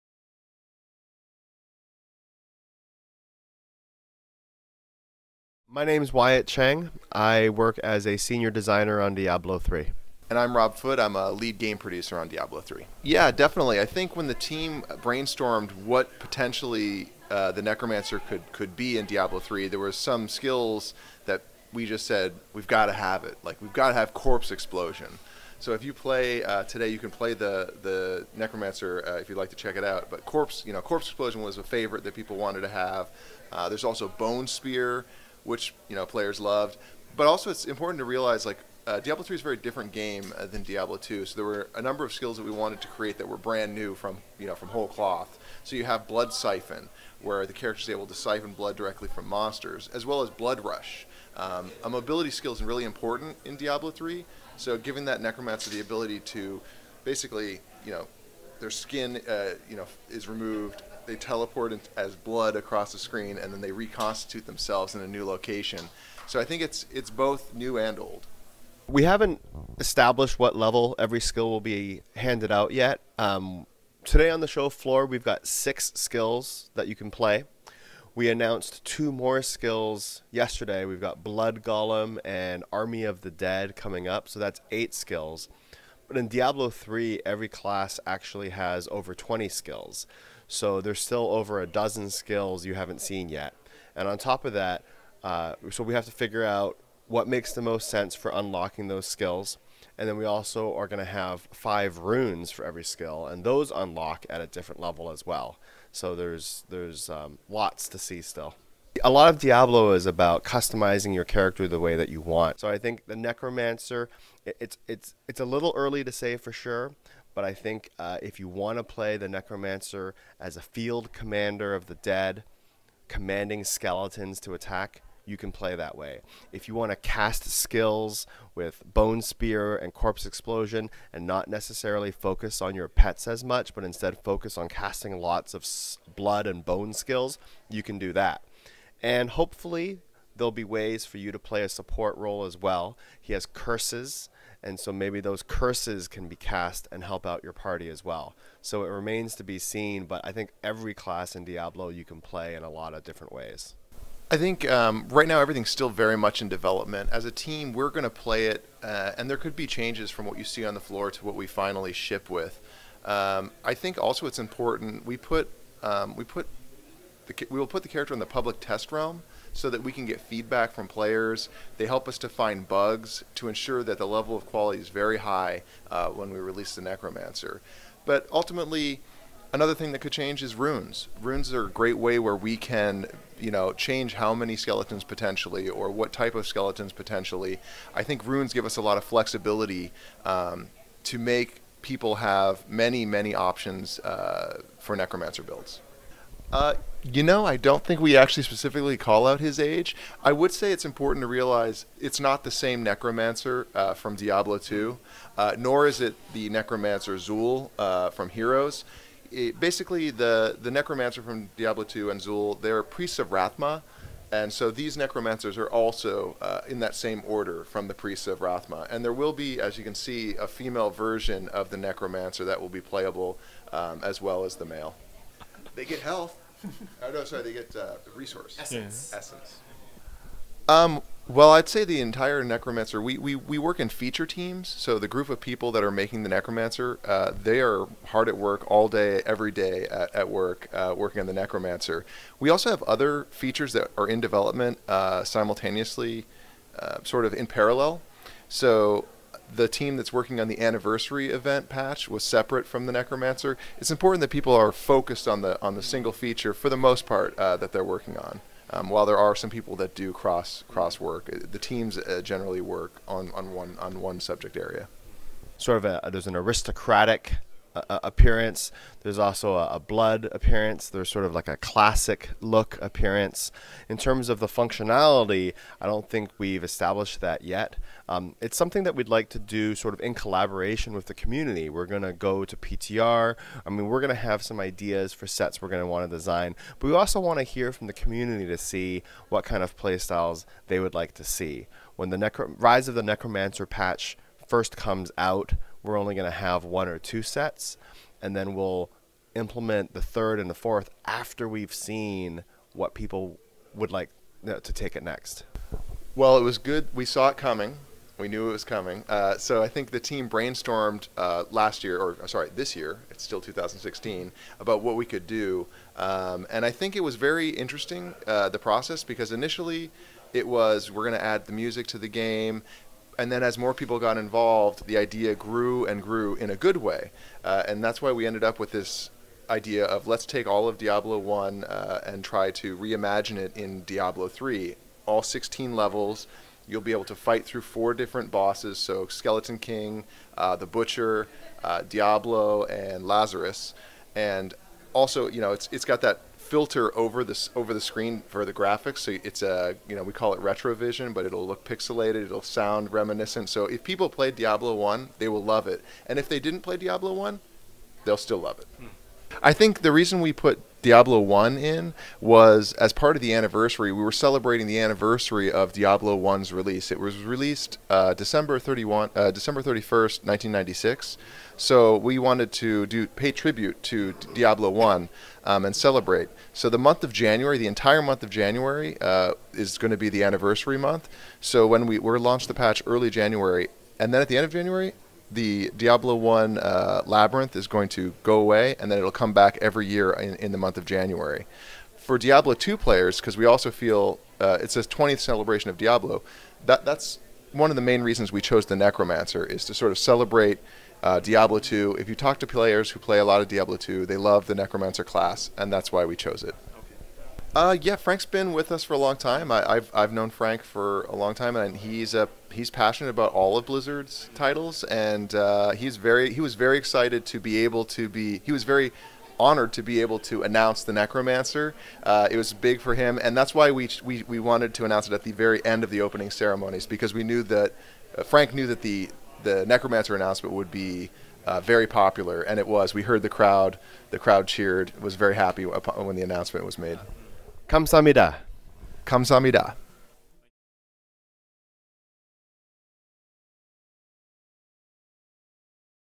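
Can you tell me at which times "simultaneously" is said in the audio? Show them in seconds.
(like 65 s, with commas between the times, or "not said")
245 s.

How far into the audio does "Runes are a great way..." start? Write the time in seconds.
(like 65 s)
181 s.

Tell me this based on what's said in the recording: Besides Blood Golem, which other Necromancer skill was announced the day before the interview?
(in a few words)
Army of the Dead.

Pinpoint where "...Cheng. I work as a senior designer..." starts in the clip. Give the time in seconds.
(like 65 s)
6 s.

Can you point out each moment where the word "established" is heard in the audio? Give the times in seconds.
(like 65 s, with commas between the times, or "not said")
69 s, 276 s.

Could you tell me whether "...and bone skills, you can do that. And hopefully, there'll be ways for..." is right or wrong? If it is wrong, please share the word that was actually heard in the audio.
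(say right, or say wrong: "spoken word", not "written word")
right.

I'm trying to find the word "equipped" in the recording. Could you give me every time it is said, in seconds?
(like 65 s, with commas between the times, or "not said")
not said.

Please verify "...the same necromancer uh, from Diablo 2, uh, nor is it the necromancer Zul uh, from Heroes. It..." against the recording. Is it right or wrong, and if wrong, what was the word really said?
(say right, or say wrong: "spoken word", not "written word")
right.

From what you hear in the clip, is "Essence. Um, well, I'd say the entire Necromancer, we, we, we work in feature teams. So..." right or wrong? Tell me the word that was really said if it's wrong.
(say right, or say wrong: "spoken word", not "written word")
right.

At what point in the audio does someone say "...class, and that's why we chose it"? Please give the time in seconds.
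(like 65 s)
405 s.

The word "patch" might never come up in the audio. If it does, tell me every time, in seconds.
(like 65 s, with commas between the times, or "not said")
251 s, 293 s, 382 s.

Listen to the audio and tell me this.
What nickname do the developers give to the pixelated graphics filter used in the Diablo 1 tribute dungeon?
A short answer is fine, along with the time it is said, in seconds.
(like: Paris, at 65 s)
retrovision, at 350 s.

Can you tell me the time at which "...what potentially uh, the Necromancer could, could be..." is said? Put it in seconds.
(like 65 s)
15 s.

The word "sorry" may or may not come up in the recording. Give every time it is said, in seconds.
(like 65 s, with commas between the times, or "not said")
227 s, 312 s.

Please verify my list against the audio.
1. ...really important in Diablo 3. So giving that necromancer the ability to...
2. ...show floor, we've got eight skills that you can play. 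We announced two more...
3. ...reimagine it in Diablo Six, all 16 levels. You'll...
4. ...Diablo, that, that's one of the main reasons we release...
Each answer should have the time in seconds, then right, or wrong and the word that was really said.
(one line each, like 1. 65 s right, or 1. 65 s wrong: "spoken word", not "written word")
1. 52 s right
2. 74 s wrong: "six", not "eight"
3. 332 s wrong: "Three", not "Six"
4. 395 s wrong: "chose", not "release".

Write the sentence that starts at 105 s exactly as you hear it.
So there's there's um, lots to see still.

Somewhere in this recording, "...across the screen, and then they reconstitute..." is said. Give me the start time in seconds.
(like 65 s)
62 s.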